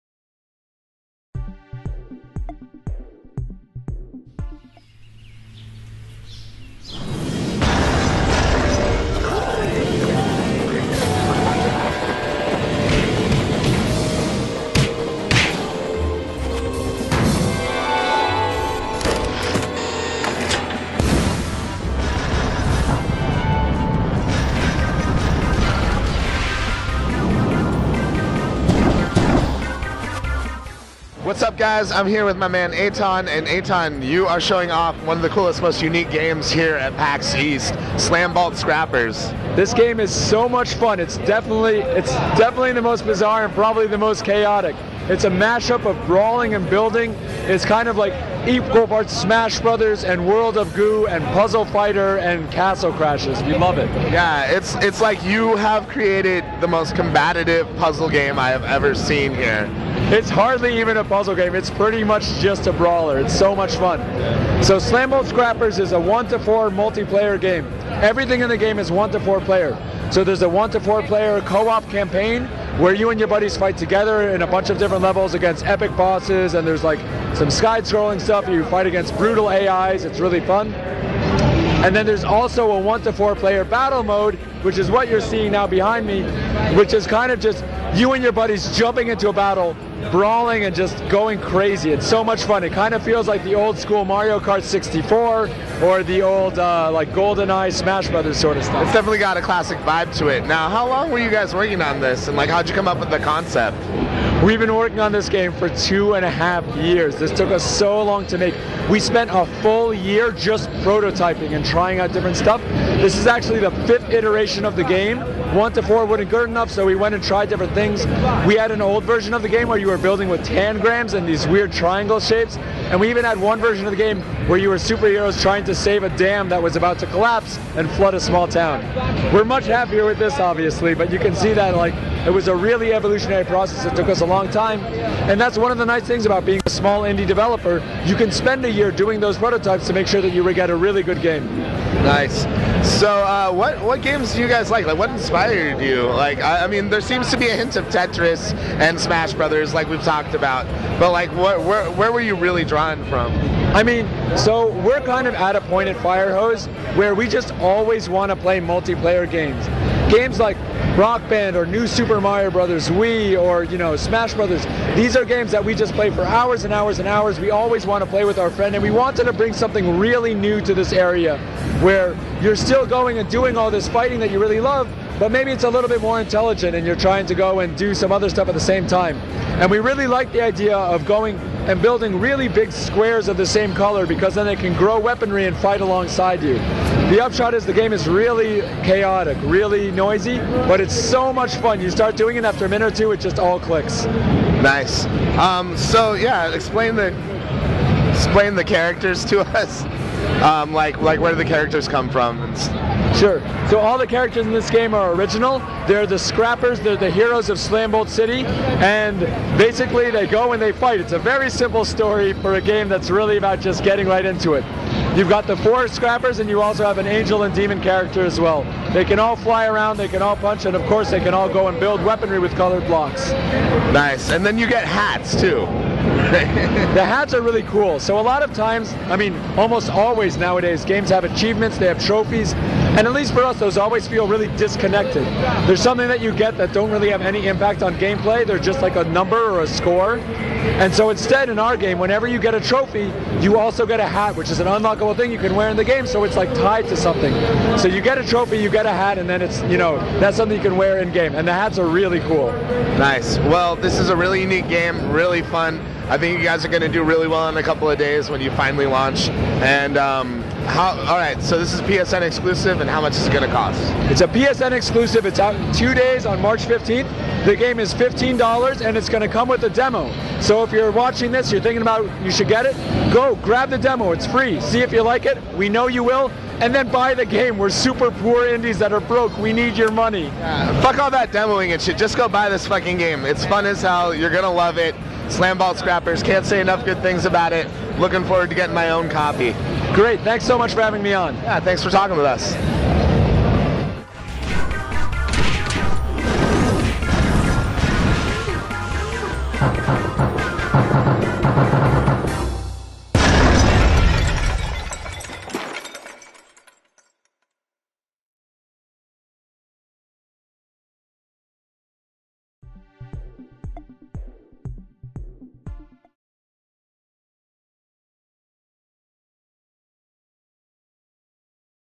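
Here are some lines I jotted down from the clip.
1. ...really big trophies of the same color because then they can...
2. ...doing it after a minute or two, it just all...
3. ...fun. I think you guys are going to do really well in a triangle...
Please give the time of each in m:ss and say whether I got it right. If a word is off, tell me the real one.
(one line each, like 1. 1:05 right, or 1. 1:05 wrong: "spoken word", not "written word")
1. 3:02 wrong: "squares", not "trophies"
2. 3:12 right
3. 4:15 wrong: "couple", not "triangle".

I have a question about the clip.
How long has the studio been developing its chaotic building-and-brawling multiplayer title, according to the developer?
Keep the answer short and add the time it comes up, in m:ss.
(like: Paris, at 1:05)
2.5 years, at 1:45.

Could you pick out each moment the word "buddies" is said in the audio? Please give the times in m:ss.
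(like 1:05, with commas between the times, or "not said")
1:13, 1:28.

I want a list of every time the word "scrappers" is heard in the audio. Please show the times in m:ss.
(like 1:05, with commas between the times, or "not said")
0:38, 1:05, 3:26, 3:35, 4:45.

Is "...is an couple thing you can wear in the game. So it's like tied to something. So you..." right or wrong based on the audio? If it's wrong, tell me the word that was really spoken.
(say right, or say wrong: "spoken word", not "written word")
wrong: "unlockable", not "couple".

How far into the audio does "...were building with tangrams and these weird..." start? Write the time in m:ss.
1:59.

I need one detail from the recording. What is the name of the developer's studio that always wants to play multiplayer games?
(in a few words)
Firehose.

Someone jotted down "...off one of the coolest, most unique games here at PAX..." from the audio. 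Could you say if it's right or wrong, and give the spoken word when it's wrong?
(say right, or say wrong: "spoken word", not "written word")
right.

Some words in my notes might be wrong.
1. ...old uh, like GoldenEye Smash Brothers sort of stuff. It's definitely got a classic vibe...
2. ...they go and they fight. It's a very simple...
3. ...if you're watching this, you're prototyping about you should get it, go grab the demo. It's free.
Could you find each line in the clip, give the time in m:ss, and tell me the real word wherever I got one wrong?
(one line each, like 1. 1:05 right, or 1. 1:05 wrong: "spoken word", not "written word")
1. 1:36 right
2. 3:30 right
3. 4:30 wrong: "thinking", not "prototyping".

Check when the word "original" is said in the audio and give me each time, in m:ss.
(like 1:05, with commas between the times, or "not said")
3:25.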